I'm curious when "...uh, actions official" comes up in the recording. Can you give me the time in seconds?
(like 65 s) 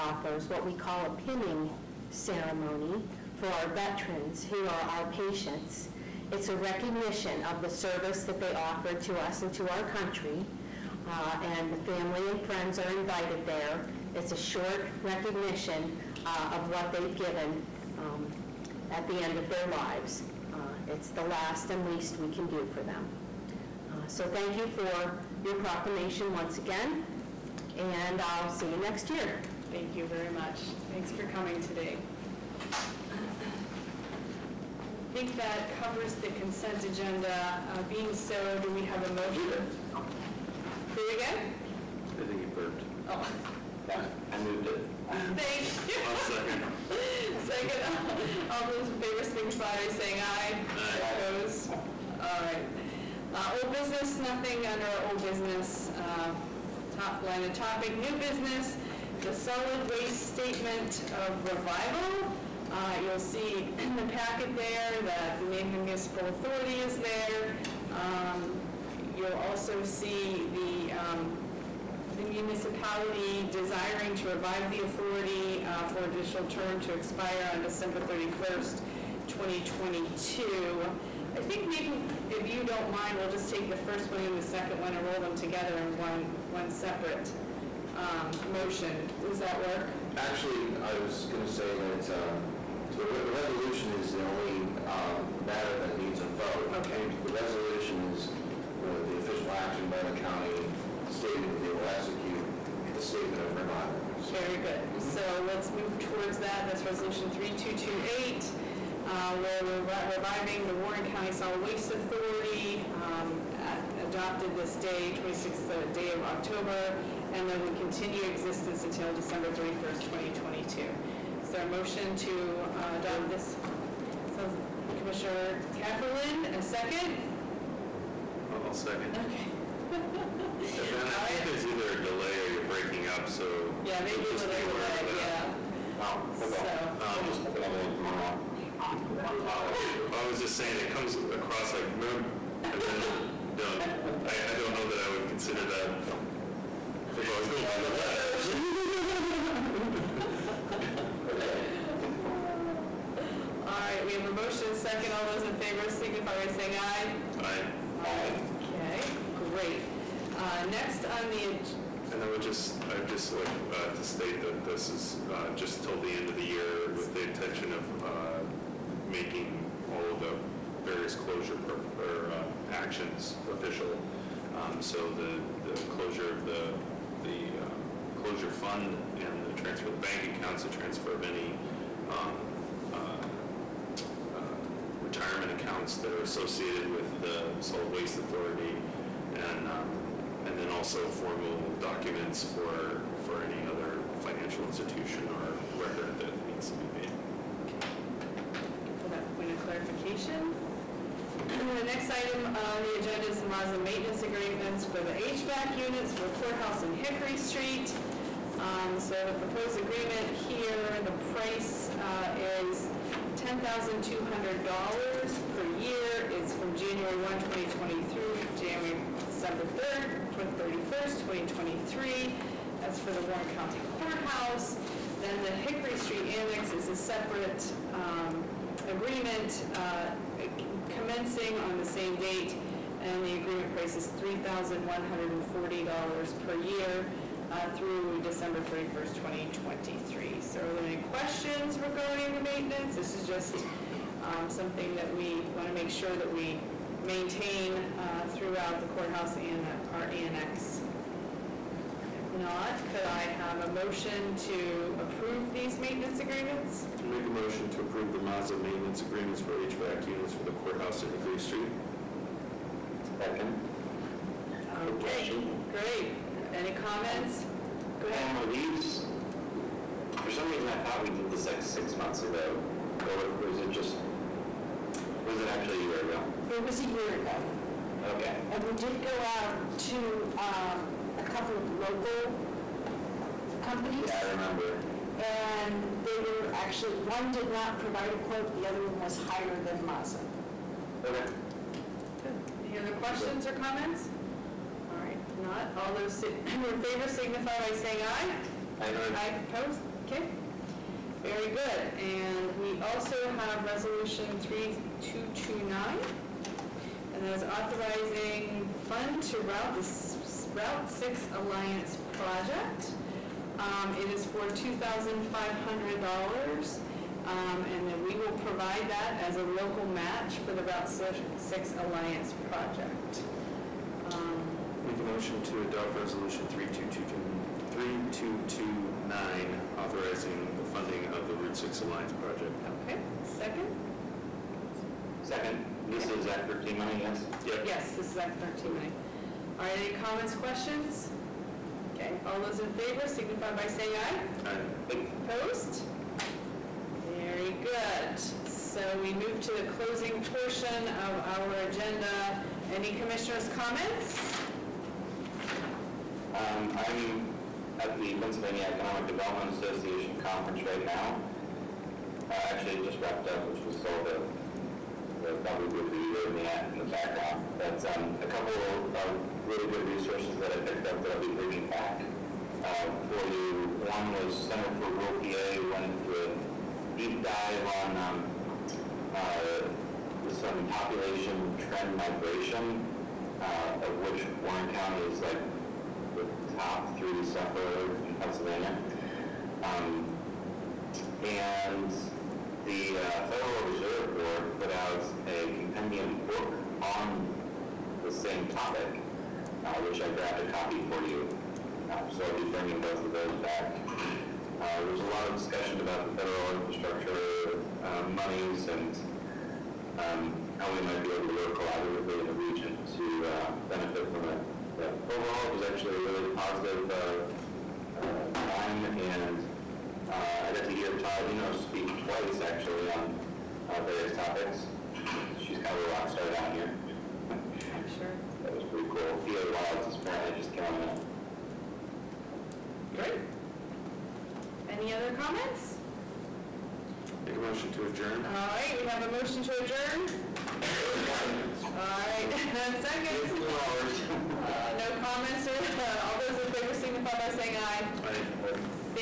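172 s.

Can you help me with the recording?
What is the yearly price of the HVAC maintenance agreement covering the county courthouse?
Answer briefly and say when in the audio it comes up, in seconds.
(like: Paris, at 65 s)
$10,200, at 213 s.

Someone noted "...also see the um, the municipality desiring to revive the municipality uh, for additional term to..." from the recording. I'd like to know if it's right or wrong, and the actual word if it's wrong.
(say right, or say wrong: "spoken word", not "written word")
wrong: "authority", not "municipality".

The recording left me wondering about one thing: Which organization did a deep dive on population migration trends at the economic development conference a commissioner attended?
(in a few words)
Center for Rural PA.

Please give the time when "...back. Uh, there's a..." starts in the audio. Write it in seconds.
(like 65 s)
403 s.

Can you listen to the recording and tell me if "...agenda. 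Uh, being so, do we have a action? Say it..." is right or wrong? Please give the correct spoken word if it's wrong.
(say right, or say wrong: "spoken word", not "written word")
wrong: "motion", not "action".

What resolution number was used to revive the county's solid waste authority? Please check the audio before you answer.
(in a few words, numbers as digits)
3228.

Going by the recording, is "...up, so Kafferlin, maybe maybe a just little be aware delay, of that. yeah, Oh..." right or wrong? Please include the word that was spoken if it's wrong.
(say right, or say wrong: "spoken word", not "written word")
wrong: "Yeah", not "Kafferlin".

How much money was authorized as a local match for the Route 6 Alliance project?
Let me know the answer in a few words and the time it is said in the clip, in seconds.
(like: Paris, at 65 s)
$2,500, at 314 s.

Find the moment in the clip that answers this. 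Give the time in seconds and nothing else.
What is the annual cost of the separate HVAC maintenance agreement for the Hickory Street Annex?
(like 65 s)
234 s.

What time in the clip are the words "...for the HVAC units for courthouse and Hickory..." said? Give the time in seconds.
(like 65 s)
204 s.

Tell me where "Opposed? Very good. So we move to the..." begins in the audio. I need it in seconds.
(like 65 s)
345 s.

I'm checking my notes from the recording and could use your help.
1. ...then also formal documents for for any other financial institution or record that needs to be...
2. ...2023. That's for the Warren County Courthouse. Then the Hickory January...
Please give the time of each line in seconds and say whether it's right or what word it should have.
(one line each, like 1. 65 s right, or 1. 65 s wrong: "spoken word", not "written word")
1. 190 s right
2. 221 s wrong: "Street", not "January".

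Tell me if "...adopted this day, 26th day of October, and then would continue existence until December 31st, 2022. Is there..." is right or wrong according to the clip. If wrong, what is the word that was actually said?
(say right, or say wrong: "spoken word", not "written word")
right.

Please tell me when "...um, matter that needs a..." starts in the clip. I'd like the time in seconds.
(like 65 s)
94 s.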